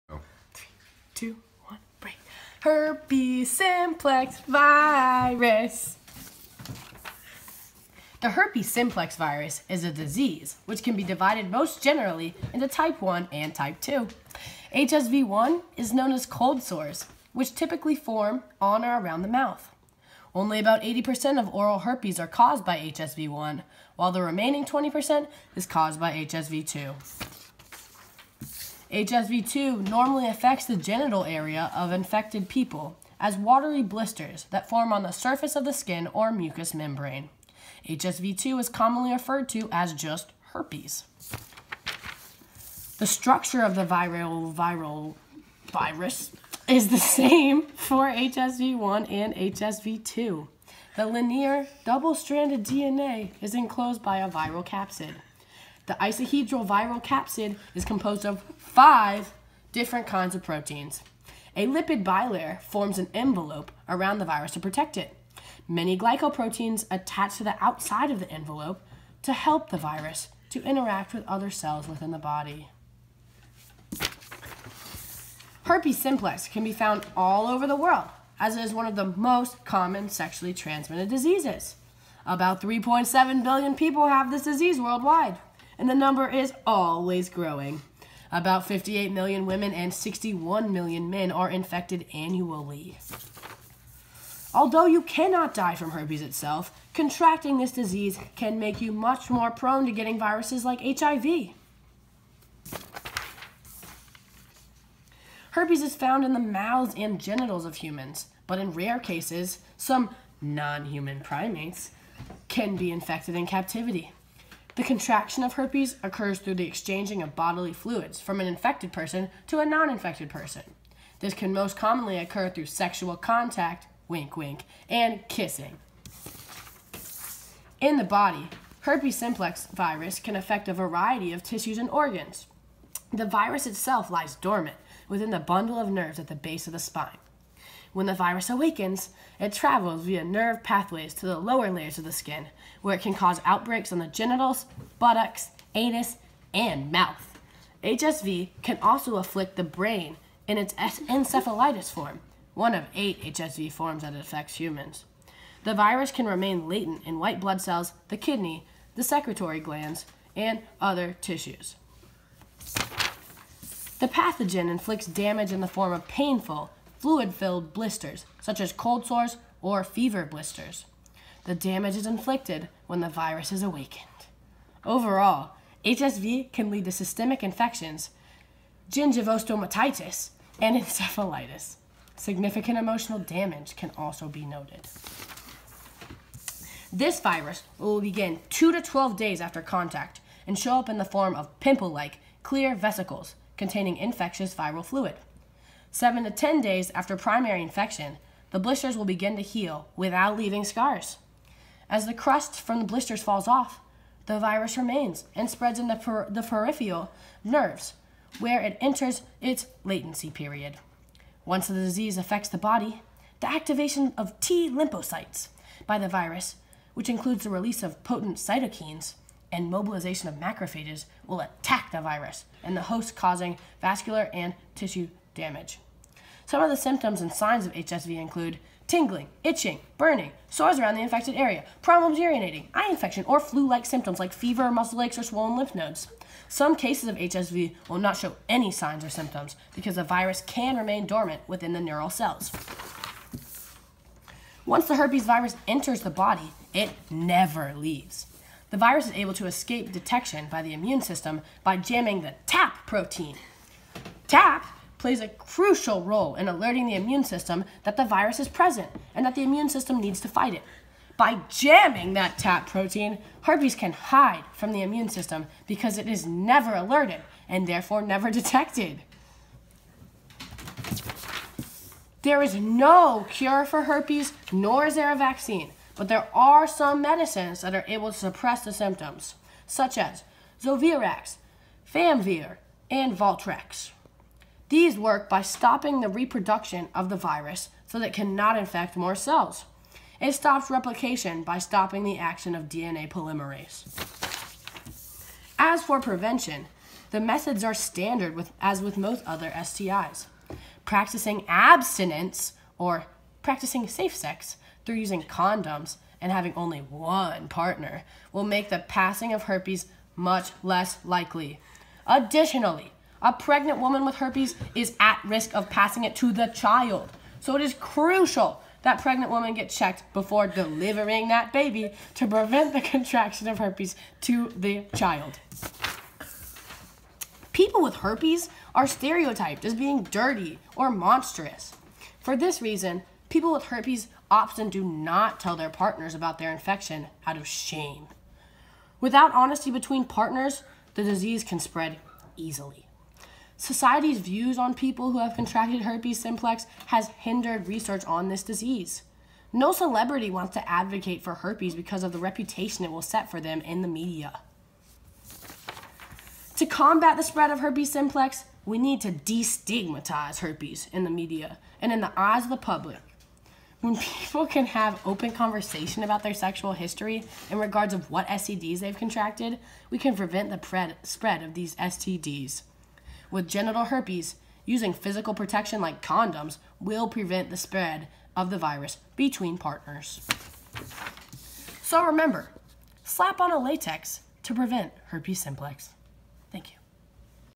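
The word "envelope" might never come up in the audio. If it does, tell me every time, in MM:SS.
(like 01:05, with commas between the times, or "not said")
01:03, 01:08.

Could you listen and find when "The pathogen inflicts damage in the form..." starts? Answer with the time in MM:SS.
02:43.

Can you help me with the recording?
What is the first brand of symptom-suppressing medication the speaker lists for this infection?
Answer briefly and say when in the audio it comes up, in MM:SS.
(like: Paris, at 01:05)
Zovirax, at 04:40.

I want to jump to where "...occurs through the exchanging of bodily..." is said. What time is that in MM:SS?
01:56.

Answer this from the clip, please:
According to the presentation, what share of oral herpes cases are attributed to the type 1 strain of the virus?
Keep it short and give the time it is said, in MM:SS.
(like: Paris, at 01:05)
80%, at 00:20.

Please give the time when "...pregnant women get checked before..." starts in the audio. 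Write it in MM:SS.
05:19.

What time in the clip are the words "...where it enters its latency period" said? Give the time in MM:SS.
03:28.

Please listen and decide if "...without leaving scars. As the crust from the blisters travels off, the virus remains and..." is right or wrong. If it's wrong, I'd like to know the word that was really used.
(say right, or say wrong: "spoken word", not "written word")
wrong: "falls", not "travels".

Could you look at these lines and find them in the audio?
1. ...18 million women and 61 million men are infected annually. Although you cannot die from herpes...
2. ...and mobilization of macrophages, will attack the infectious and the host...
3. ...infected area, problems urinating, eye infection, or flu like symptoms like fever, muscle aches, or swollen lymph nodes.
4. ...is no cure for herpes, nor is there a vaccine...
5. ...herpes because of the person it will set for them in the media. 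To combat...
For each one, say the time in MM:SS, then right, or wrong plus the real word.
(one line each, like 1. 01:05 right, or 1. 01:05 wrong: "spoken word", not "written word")
1. 01:28 wrong: "58", not "18"
2. 03:39 wrong: "virus", not "infectious"
3. 03:51 right
4. 04:32 right
5. 05:51 wrong: "reputation", not "person".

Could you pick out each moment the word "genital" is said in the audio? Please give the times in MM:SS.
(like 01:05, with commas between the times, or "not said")
00:30, 01:47, 02:24, 06:13.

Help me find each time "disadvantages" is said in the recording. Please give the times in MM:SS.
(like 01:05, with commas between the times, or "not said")
not said.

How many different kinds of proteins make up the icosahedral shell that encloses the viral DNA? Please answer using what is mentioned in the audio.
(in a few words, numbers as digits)
5.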